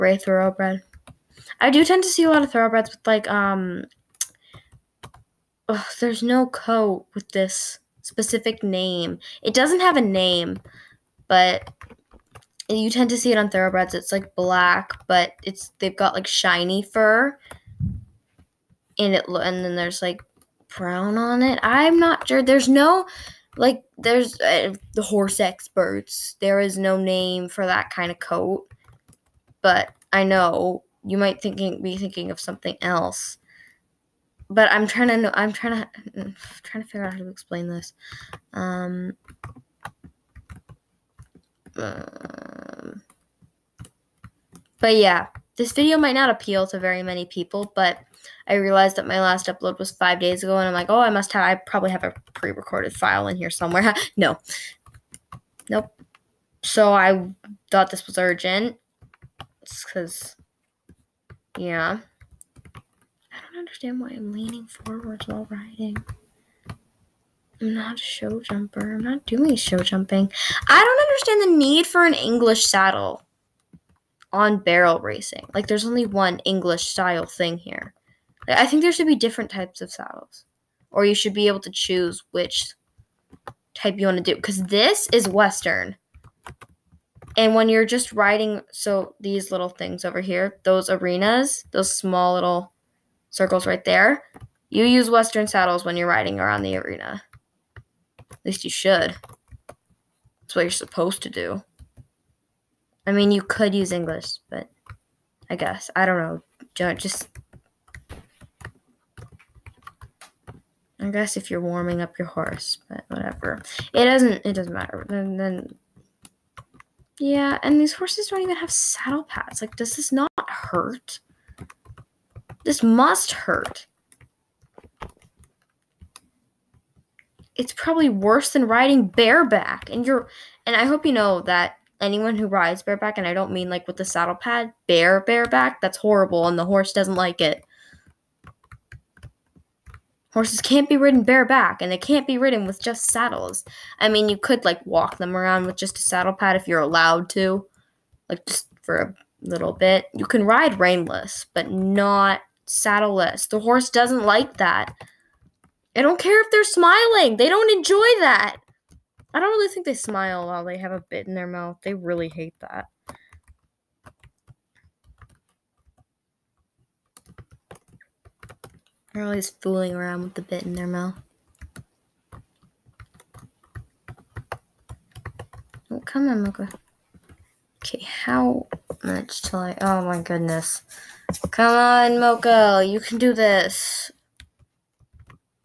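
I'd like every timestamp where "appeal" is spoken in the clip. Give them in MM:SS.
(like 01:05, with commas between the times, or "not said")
00:46.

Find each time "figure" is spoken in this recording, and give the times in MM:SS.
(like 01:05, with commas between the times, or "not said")
00:36.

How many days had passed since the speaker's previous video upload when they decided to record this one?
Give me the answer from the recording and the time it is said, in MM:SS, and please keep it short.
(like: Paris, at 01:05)
5, at 00:49.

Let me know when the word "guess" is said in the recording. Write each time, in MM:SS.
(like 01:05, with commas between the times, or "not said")
01:45, 01:51.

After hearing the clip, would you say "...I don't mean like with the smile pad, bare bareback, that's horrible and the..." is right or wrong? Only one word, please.
wrong.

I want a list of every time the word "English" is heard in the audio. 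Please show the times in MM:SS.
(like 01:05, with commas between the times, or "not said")
01:12, 01:16, 01:43.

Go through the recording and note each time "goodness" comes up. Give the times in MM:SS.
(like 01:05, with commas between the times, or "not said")
03:00.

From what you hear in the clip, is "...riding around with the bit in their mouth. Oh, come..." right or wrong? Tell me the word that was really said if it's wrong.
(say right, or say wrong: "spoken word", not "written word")
wrong: "fooling", not "riding".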